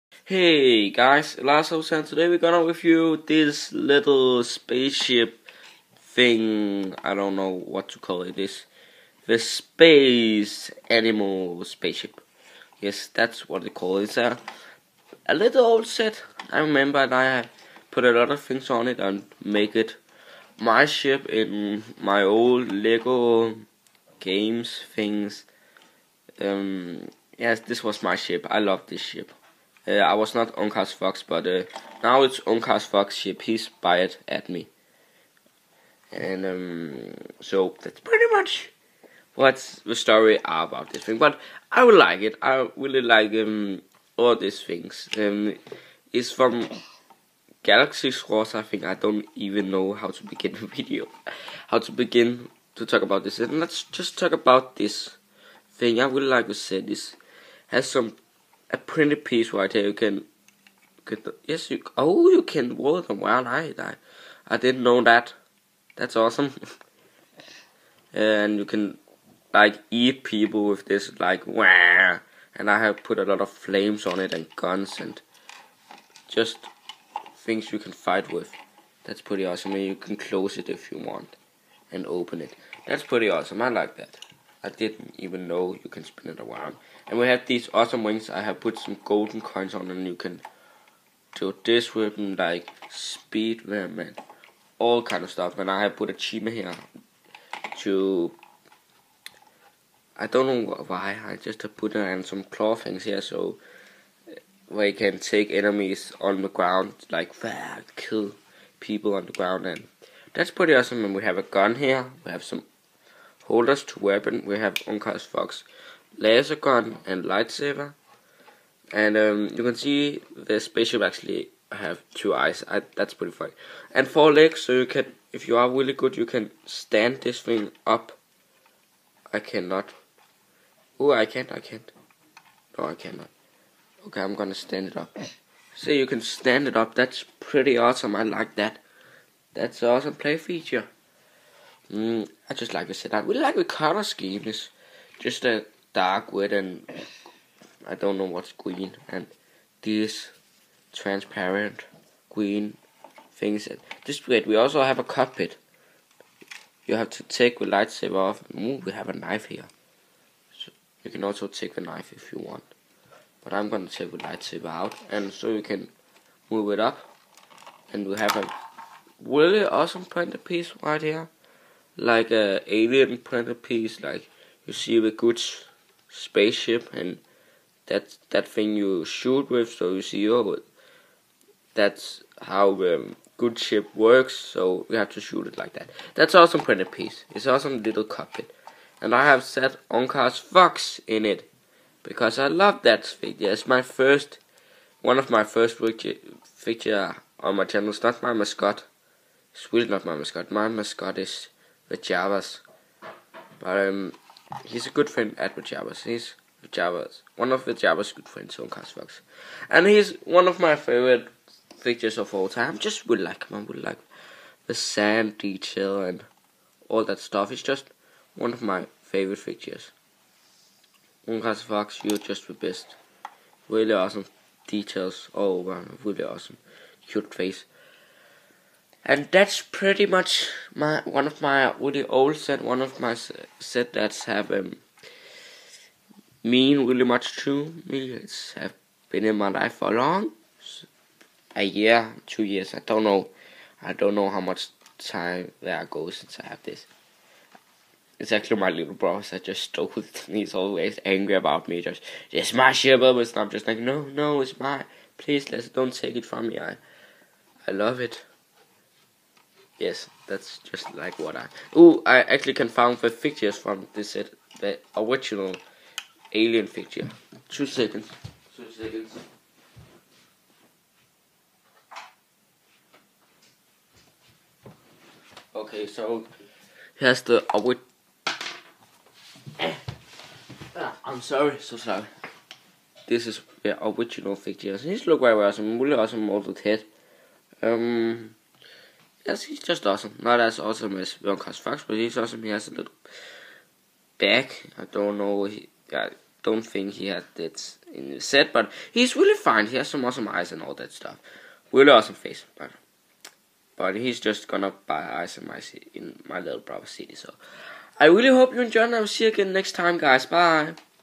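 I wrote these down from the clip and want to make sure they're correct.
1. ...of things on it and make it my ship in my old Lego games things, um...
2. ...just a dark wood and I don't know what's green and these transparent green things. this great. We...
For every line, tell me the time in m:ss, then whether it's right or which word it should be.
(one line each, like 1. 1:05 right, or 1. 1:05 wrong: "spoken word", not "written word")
1. 0:18 right
2. 2:25 right.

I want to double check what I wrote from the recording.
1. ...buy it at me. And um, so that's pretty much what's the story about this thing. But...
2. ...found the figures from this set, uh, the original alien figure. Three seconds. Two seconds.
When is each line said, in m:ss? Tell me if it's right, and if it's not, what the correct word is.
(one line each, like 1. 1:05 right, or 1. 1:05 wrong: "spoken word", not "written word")
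1. 0:33 right
2. 4:22 wrong: "Two", not "Three".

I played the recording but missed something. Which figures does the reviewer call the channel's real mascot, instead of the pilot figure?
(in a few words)
the Javas.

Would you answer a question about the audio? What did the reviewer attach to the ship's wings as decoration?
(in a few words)
golden coins.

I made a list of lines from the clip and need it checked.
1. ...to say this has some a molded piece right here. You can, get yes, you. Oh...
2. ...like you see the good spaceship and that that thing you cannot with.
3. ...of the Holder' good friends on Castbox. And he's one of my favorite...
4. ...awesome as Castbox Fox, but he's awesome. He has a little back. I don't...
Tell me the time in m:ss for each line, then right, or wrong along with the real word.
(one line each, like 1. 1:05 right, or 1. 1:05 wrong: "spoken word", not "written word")
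1. 0:56 wrong: "printed", not "molded"
2. 2:54 wrong: "shoot", not "cannot"
3. 3:27 wrong: "Javas", not "Holder"
4. 4:50 wrong: "Wilcox", not "Castbox".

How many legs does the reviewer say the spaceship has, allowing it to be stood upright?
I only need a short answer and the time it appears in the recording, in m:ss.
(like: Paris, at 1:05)
4, at 2:04.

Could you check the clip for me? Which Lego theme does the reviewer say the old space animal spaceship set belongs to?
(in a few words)
Galaxy Wars.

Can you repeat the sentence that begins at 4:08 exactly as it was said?
It's actually my little brother that just stole it.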